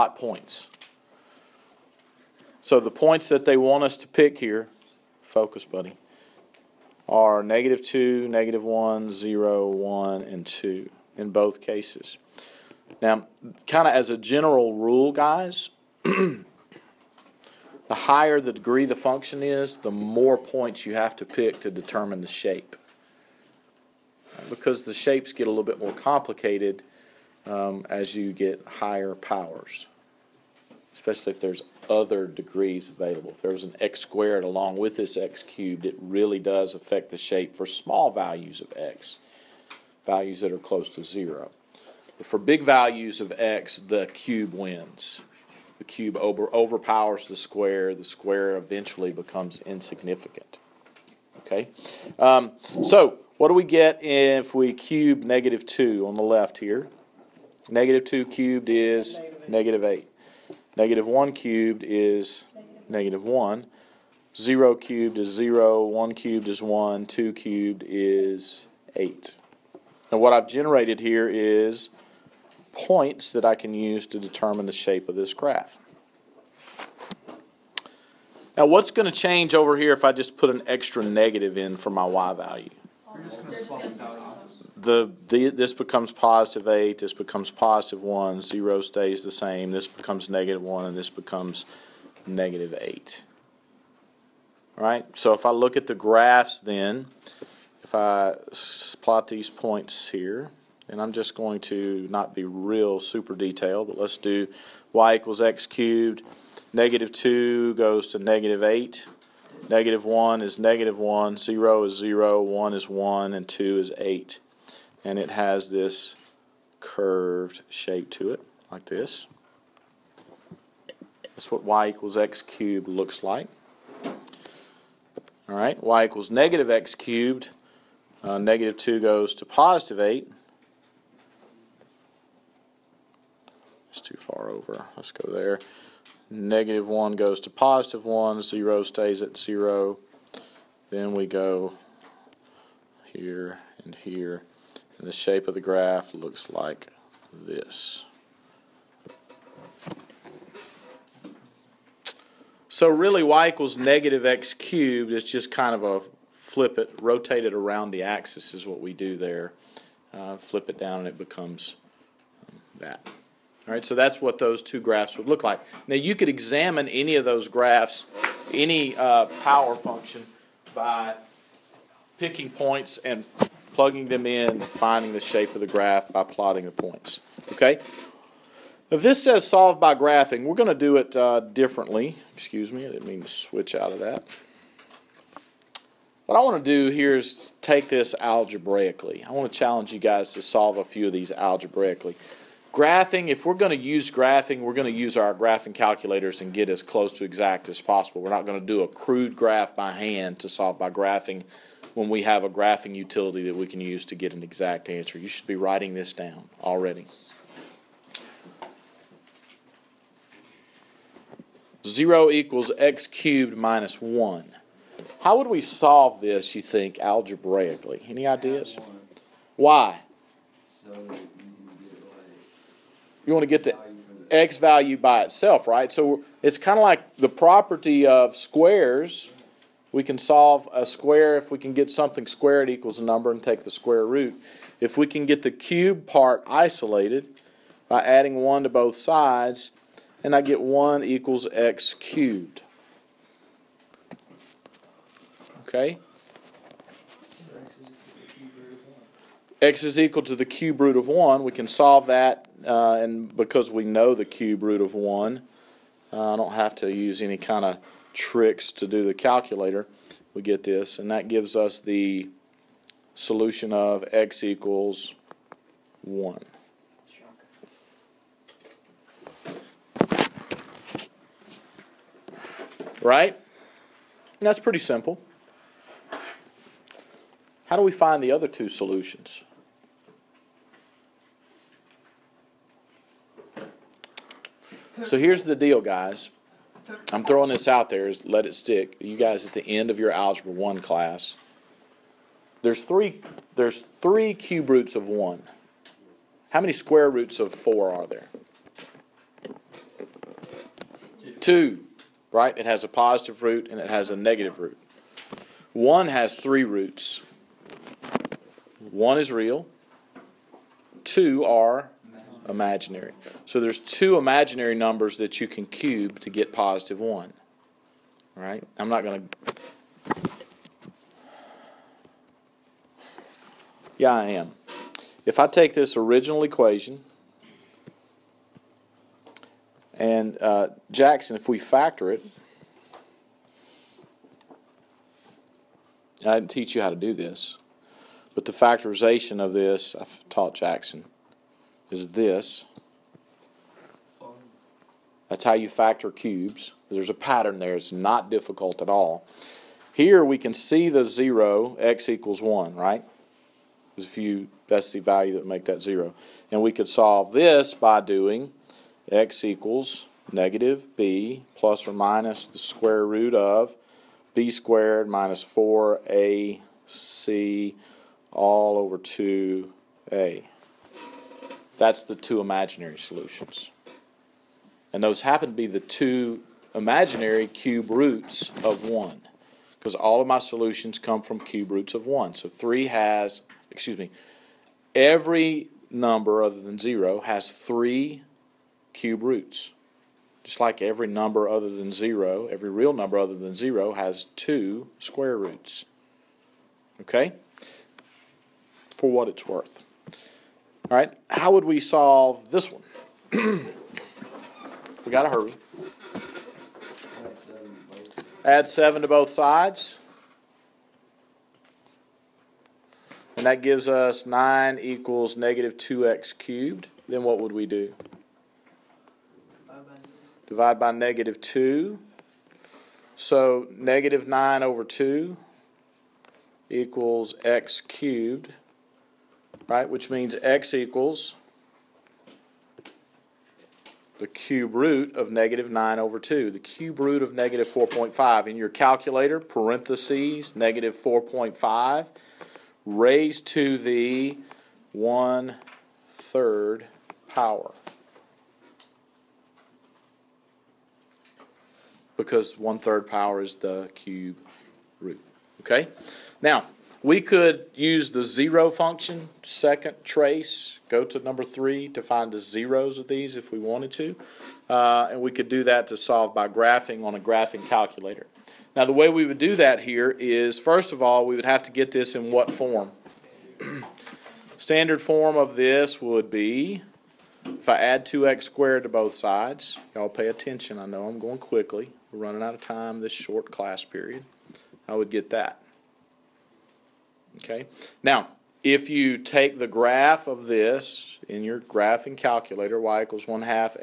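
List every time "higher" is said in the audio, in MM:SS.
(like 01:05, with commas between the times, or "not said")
00:17, 00:28.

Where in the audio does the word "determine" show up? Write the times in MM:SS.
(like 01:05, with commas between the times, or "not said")
00:21, 01:14.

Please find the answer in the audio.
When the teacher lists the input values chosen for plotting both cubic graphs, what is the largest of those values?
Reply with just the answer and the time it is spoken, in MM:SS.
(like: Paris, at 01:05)
2, at 00:10.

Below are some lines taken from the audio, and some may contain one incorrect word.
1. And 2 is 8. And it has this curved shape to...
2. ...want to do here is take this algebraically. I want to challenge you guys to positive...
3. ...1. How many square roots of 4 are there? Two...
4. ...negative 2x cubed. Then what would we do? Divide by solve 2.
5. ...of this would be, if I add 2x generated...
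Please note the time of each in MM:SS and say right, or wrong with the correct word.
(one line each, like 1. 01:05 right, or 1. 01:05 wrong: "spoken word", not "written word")
1. 01:53 right
2. 03:06 wrong: "solve", not "positive"
3. 04:55 right
4. 06:55 wrong: "negative", not "solve"
5. 07:55 wrong: "squared", not "generated".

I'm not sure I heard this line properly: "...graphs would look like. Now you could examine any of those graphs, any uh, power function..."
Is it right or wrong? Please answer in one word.
right.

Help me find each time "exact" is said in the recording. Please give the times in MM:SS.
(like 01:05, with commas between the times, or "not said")
03:17, 03:24.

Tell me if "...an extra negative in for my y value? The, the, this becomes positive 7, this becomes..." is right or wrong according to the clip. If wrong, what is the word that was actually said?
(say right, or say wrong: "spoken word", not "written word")
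wrong: "8", not "7".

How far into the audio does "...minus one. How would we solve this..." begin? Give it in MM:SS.
03:33.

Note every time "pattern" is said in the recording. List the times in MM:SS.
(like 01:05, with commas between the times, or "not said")
05:47.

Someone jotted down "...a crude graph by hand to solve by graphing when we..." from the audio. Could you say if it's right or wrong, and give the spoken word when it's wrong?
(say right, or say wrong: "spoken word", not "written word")
right.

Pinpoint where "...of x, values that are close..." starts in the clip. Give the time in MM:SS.
00:38.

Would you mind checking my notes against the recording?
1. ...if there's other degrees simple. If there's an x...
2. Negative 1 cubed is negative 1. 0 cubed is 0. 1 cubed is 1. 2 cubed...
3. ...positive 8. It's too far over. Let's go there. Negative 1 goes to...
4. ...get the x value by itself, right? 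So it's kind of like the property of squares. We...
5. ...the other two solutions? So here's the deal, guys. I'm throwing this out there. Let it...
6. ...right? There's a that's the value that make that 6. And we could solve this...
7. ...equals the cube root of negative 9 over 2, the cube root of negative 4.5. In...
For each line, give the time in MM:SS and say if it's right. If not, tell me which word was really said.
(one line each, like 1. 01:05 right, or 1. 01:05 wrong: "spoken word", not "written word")
1. 00:31 wrong: "available", not "simple"
2. 01:00 right
3. 02:09 right
4. 03:43 right
5. 04:38 right
6. 05:52 wrong: "0", not "6"
7. 07:10 right.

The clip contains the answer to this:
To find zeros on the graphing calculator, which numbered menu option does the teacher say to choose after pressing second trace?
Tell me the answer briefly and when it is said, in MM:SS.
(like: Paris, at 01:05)
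3, at 07:41.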